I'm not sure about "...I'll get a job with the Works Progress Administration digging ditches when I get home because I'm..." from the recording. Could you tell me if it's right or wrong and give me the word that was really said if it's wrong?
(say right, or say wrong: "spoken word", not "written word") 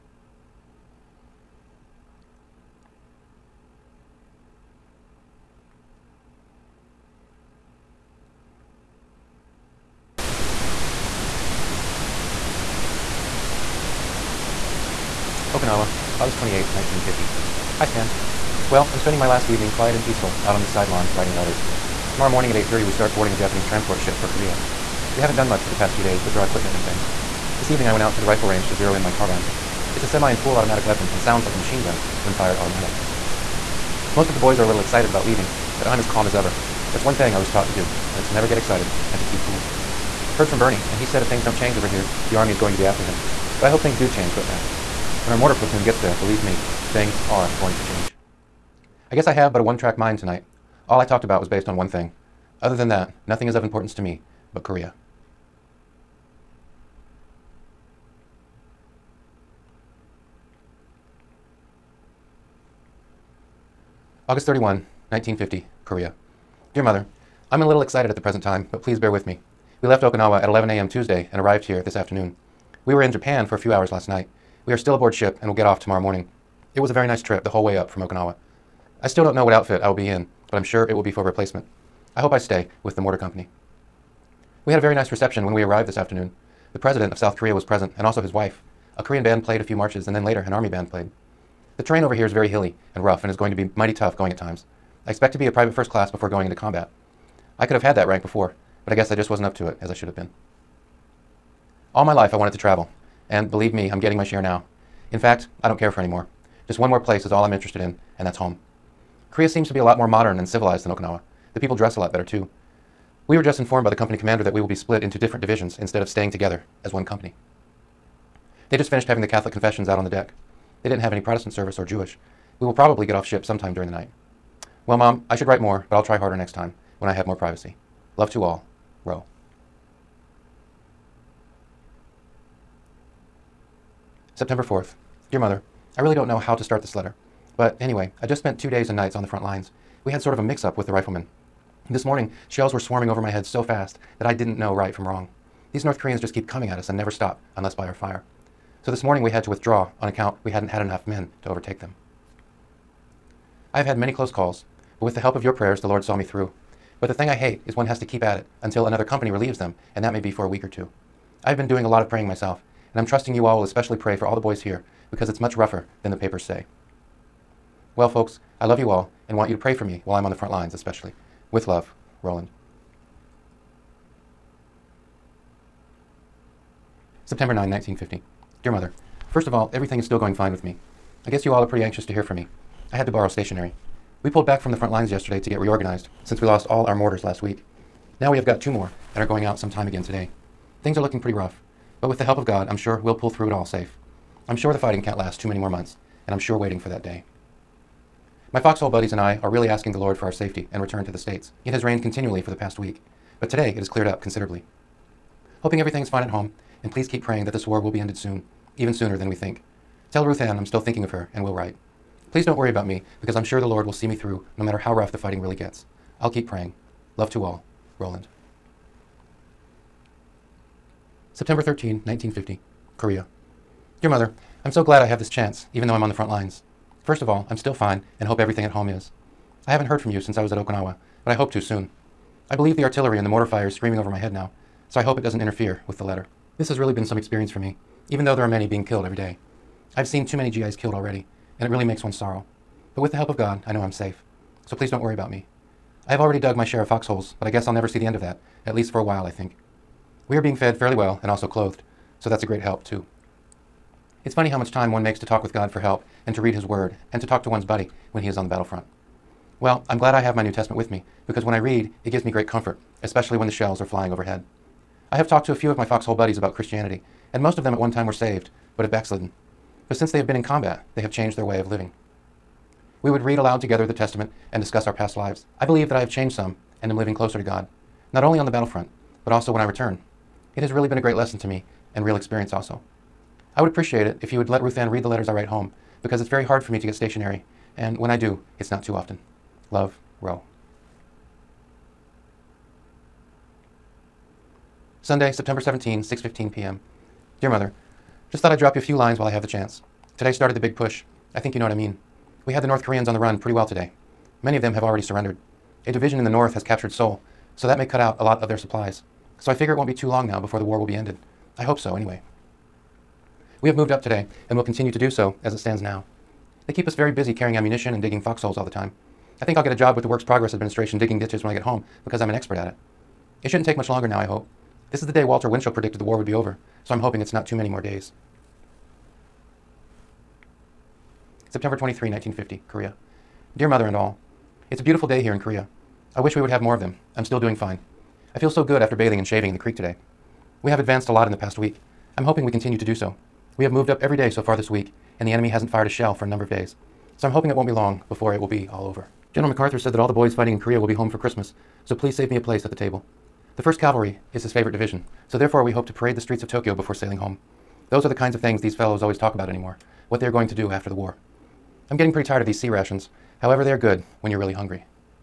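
right.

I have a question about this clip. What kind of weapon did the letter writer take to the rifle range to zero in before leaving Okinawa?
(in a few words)
carbine.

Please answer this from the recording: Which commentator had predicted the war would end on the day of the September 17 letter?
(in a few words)
Walter Winchell.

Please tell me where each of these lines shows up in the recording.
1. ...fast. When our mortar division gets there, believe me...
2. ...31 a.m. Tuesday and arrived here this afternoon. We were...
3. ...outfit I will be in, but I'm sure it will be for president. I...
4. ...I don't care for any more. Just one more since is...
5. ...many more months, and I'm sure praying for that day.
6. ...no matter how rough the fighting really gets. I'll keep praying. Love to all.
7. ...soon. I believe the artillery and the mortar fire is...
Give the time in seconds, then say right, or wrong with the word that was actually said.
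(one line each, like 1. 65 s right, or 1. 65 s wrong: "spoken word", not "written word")
1. 44 s wrong: "platoon", not "division"
2. 70 s wrong: "11", not "31"
3. 79 s wrong: "replacement", not "president"
4. 105 s wrong: "place", not "since"
5. 195 s wrong: "waiting", not "praying"
6. 214 s right
7. 231 s right.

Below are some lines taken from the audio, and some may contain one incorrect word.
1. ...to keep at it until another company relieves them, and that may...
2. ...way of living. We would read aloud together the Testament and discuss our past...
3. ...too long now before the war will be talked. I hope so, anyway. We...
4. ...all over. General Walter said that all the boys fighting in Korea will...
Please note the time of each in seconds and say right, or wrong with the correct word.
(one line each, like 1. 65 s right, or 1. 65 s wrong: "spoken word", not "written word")
1. 157 s right
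2. 271 s right
3. 309 s wrong: "ended", not "talked"
4. 348 s wrong: "MacArthur", not "Walter".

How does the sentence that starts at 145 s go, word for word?
These North Koreans just keep coming at us and never stop unless by our fire.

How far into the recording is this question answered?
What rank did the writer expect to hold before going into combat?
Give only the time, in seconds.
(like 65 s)
95 s.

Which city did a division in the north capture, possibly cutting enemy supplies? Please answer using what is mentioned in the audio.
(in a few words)
Seoul.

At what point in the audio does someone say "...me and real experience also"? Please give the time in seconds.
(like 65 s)
281 s.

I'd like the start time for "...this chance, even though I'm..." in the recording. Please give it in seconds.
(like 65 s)
225 s.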